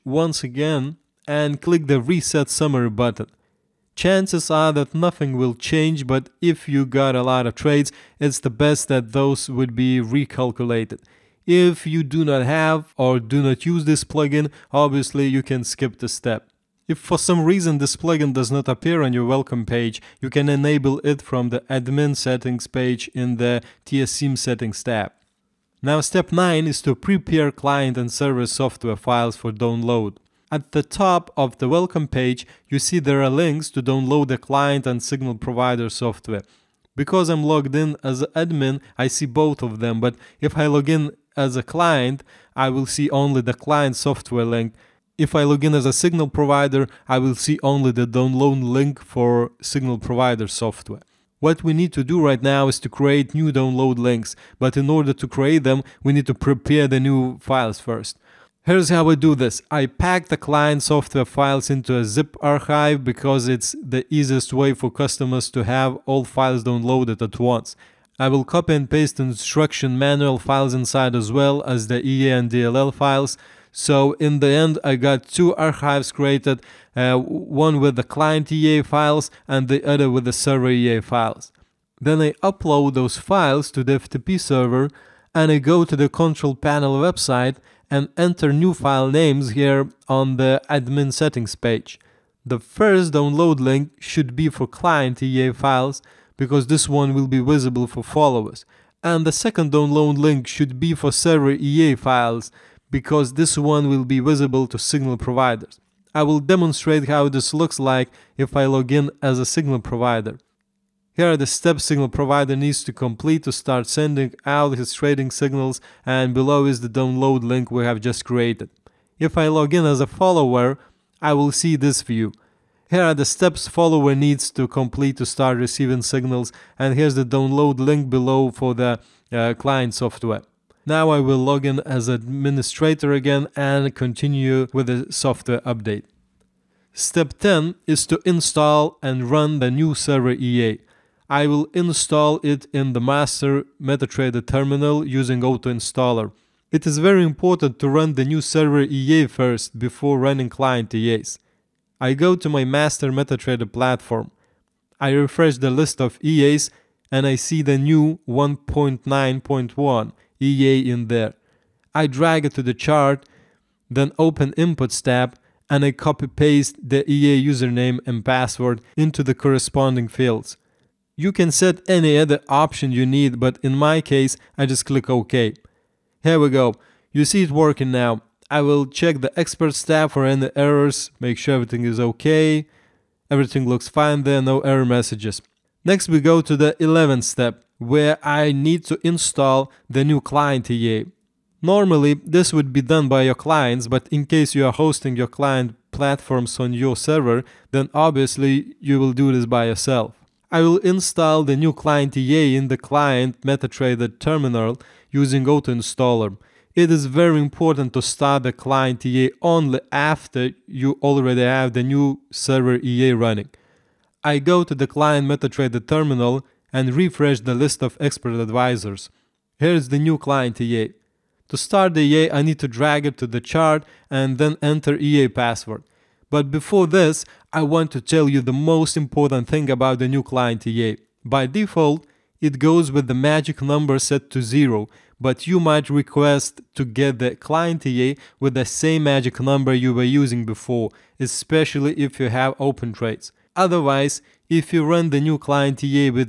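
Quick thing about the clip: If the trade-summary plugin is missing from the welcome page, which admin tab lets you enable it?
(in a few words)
TSM settings tab.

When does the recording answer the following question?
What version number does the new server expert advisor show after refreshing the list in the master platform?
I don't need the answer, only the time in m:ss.
2:38.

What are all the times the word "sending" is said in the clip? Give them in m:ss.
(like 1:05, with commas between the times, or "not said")
1:53.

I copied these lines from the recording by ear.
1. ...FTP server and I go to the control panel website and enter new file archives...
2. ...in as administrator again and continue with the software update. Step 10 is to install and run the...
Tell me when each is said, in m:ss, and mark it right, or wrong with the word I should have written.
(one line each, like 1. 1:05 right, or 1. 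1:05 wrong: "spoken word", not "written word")
1. 1:23 wrong: "names", not "archives"
2. 2:11 right.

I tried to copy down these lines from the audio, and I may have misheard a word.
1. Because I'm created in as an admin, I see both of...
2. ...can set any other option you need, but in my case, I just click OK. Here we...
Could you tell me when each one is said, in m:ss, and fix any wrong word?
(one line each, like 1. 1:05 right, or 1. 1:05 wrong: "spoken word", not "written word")
1. 0:36 wrong: "logged", not "created"
2. 2:51 right.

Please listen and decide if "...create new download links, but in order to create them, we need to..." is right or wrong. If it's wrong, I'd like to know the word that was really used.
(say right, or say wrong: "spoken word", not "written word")
right.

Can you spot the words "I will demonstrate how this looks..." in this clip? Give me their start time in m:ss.
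1:46.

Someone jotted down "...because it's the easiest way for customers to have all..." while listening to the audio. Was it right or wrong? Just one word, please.
right.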